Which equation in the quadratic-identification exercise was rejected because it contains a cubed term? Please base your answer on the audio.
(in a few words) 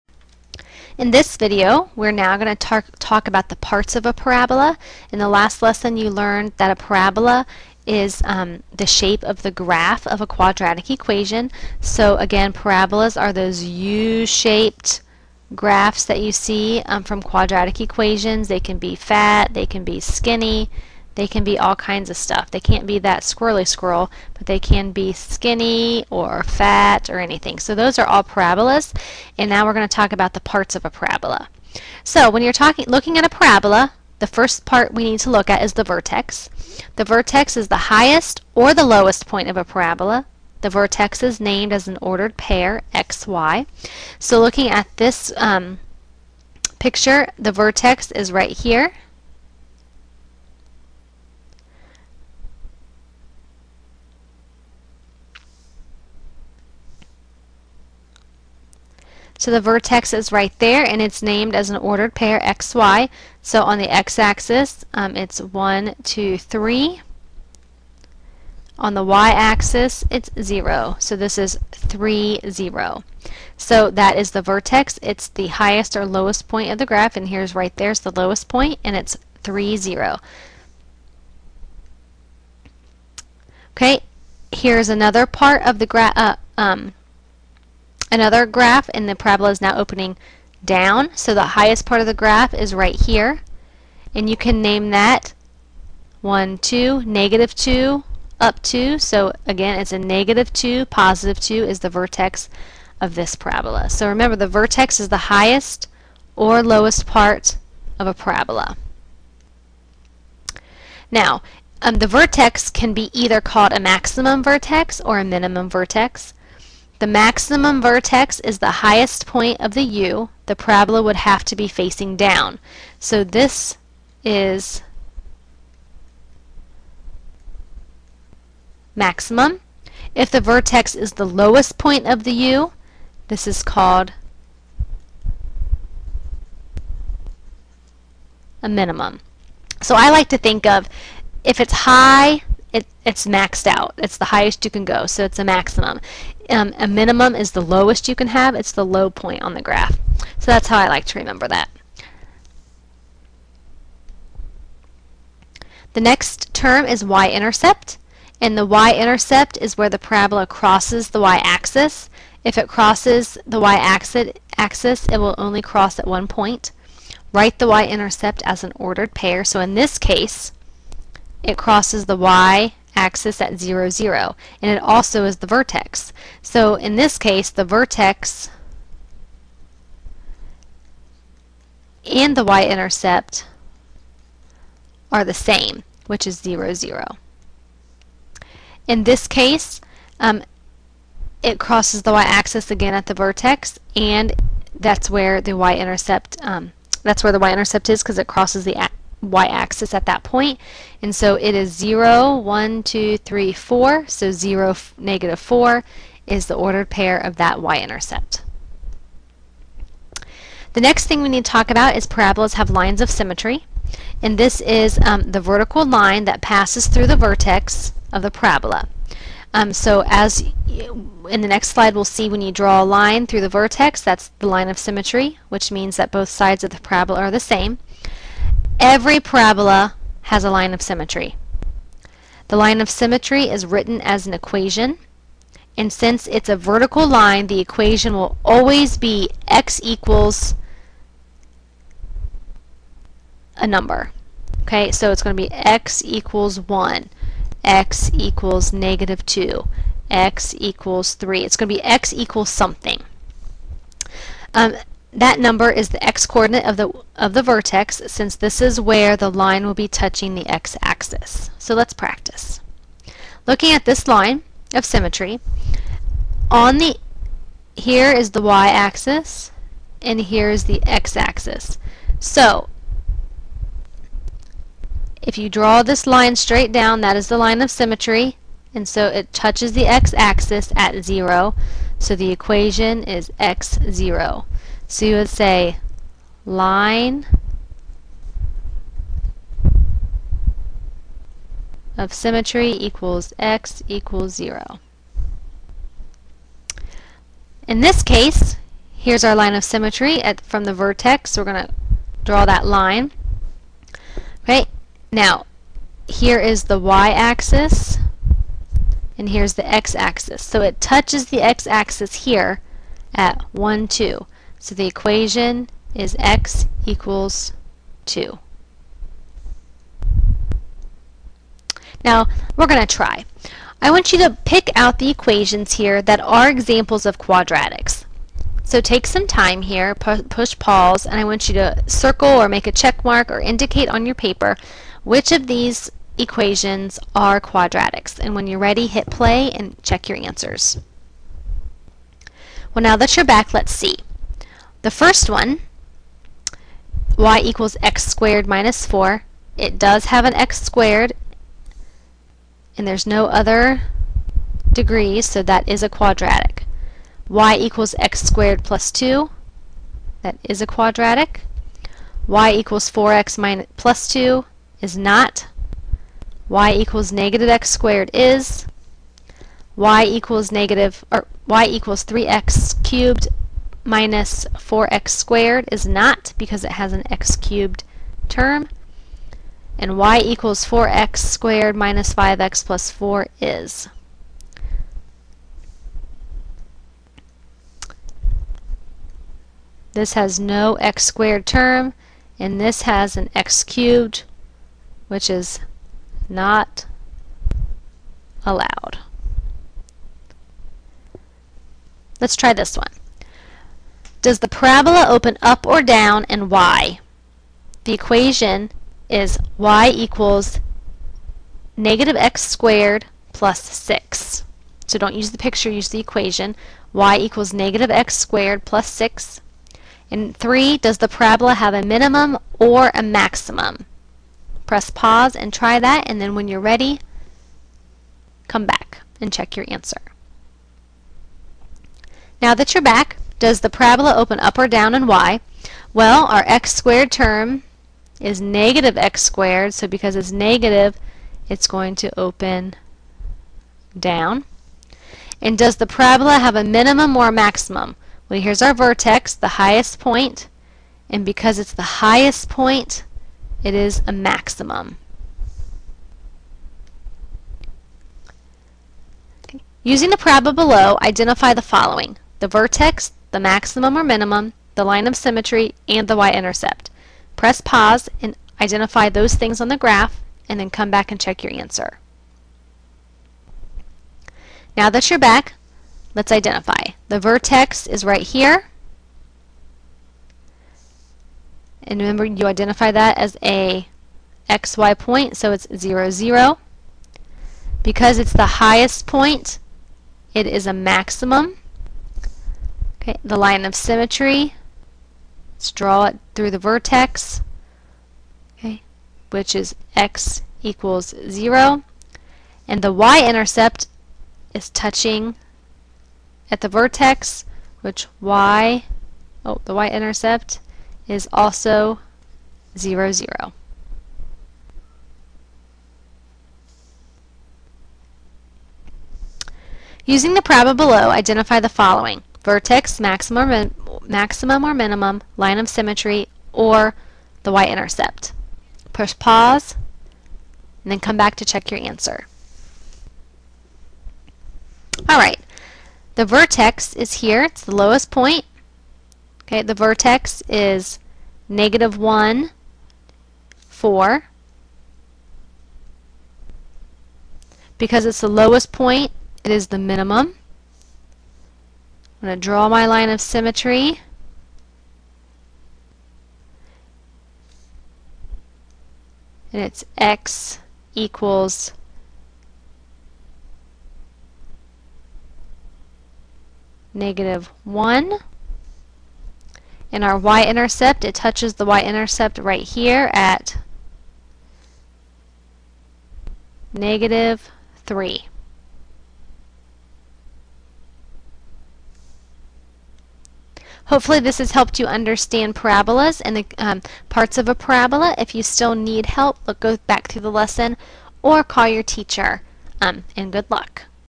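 y = 3x^3 - 4x^2.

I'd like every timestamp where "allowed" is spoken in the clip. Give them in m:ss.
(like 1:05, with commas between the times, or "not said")
6:38.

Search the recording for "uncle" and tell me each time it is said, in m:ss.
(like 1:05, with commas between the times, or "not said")
not said.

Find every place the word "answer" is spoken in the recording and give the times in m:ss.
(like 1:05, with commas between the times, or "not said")
5:40, 7:09, 7:51, 8:51.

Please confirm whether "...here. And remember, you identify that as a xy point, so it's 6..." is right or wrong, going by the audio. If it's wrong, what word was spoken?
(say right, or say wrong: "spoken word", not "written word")
wrong: "0", not "6".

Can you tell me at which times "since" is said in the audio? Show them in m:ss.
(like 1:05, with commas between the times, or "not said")
3:55, 4:18.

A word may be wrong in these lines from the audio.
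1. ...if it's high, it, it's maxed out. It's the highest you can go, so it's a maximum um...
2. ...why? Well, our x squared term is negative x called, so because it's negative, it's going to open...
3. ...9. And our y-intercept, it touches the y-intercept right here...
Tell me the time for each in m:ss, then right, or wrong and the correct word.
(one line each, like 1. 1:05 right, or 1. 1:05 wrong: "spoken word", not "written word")
1. 2:21 right
2. 7:15 wrong: "squared", not "called"
3. 9:27 wrong: "1", not "9".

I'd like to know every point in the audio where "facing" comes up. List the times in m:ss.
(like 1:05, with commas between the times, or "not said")
2:01.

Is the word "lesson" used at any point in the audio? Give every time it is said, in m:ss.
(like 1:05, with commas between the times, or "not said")
0:05, 9:50.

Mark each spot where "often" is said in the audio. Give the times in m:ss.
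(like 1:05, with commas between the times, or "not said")
not said.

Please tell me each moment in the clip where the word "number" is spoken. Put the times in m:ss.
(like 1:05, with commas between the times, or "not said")
4:03, 4:15.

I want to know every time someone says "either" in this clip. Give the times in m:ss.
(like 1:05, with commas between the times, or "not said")
1:53.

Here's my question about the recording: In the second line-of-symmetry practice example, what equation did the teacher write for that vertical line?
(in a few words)
x = 2.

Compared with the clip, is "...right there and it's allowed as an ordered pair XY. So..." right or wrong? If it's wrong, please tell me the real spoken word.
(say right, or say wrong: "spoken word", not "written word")
wrong: "named", not "allowed".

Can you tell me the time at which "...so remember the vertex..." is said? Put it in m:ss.
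1:43.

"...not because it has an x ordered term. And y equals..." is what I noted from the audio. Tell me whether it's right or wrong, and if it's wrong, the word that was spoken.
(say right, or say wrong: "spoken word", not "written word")
wrong: "cubed", not "ordered".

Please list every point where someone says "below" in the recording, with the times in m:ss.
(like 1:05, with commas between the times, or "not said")
7:40, 8:40.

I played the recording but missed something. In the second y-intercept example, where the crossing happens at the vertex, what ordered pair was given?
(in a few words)
(0, -4).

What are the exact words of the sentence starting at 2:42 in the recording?
If it crosses the y-axis, it will only cross at one point.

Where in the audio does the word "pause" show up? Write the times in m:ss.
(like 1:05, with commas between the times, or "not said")
5:30, 7:04, 7:47, 8:49.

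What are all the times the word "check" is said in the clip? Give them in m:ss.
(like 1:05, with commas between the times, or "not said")
5:32, 5:39, 7:09, 7:51, 8:51.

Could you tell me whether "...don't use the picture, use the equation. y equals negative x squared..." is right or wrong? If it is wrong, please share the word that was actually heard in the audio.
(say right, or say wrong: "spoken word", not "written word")
right.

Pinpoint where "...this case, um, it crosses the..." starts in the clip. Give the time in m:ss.
3:09.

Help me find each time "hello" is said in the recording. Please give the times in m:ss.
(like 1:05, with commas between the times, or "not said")
not said.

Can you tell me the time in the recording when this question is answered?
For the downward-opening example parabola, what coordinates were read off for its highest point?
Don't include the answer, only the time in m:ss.
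1:39.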